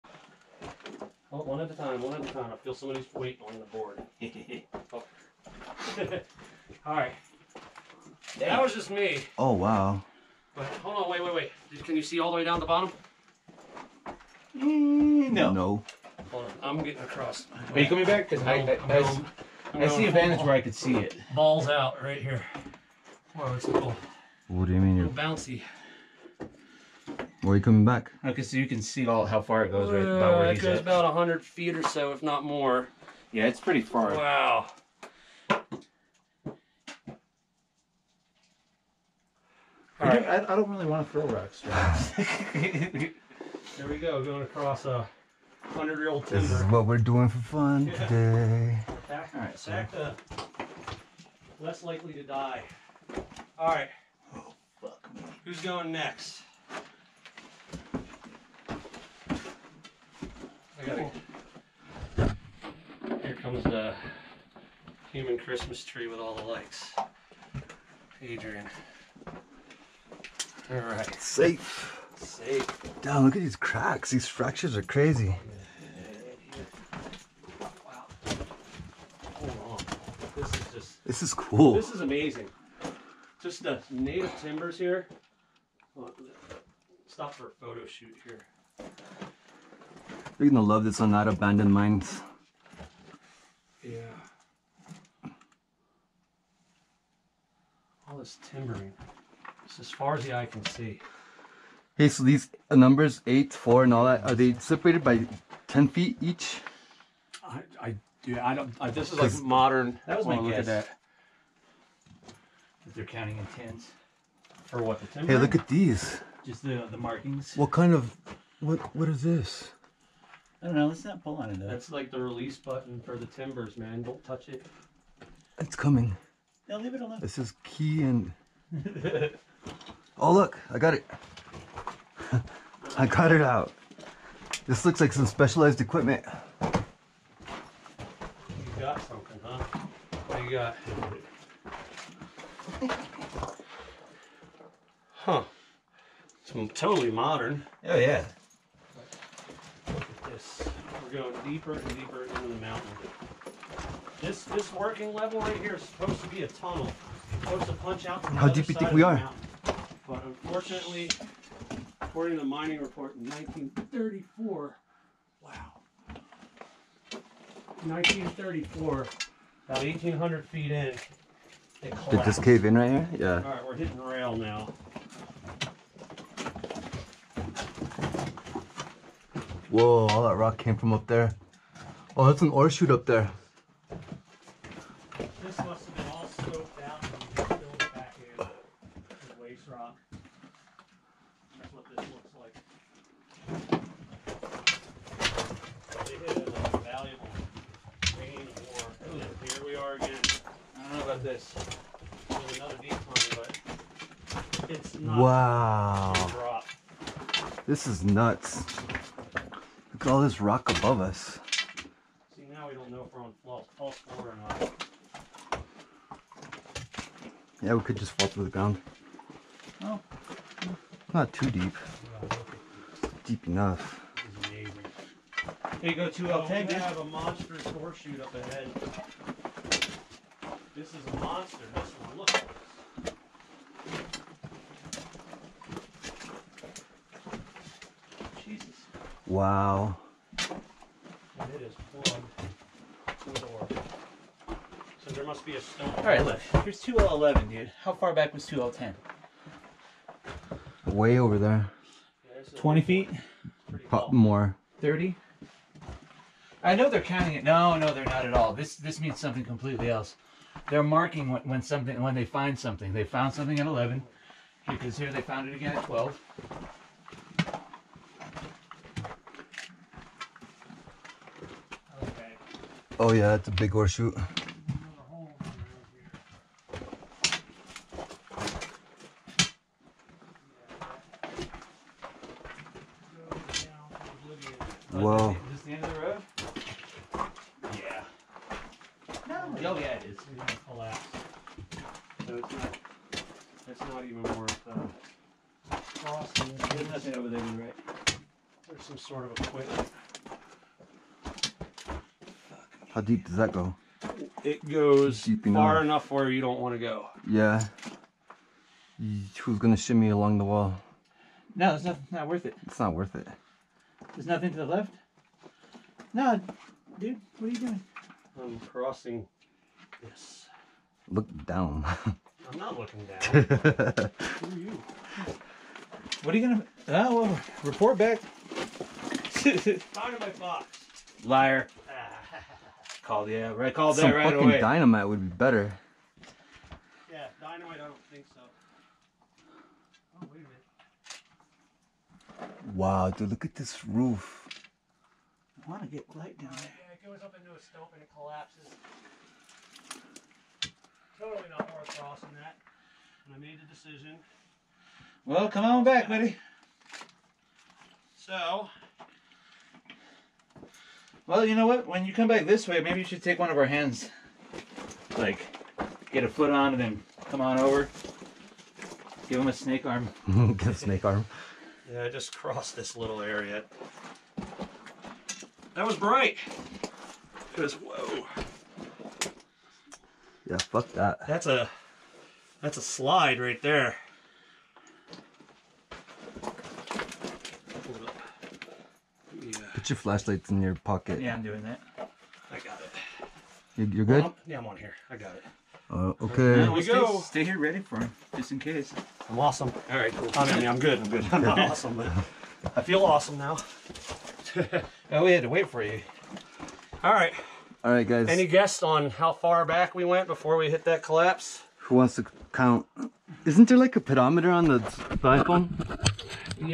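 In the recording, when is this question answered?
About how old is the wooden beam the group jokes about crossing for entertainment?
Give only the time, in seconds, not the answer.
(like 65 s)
45 s.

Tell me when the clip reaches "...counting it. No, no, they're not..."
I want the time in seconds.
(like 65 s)
256 s.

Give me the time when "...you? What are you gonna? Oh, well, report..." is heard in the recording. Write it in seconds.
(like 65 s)
324 s.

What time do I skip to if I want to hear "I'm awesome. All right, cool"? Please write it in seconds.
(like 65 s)
399 s.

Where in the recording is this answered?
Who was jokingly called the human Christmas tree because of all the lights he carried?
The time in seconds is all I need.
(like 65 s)
68 s.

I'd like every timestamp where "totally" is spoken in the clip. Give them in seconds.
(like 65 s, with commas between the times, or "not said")
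146 s, 351 s.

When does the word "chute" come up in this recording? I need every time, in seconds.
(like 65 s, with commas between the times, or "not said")
182 s.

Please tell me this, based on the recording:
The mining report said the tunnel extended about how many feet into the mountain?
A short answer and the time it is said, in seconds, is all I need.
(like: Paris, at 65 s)
1800 feet, at 169 s.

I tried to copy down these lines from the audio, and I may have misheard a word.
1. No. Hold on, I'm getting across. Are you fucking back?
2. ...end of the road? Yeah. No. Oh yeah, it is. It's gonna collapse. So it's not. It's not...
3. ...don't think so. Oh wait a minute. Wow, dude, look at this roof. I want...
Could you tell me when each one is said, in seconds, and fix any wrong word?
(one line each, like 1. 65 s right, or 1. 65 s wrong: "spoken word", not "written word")
1. 15 s wrong: "coming", not "fucking"
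2. 285 s right
3. 337 s right.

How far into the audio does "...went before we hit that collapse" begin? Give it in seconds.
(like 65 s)
410 s.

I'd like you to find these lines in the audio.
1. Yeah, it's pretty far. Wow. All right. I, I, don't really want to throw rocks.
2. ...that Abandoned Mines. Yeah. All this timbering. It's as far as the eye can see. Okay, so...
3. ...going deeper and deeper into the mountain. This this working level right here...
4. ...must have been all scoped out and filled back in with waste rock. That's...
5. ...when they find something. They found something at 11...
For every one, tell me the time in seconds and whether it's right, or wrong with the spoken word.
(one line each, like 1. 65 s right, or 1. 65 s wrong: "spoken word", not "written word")
1. 33 s right
2. 91 s right
3. 151 s right
4. 185 s right
5. 262 s right.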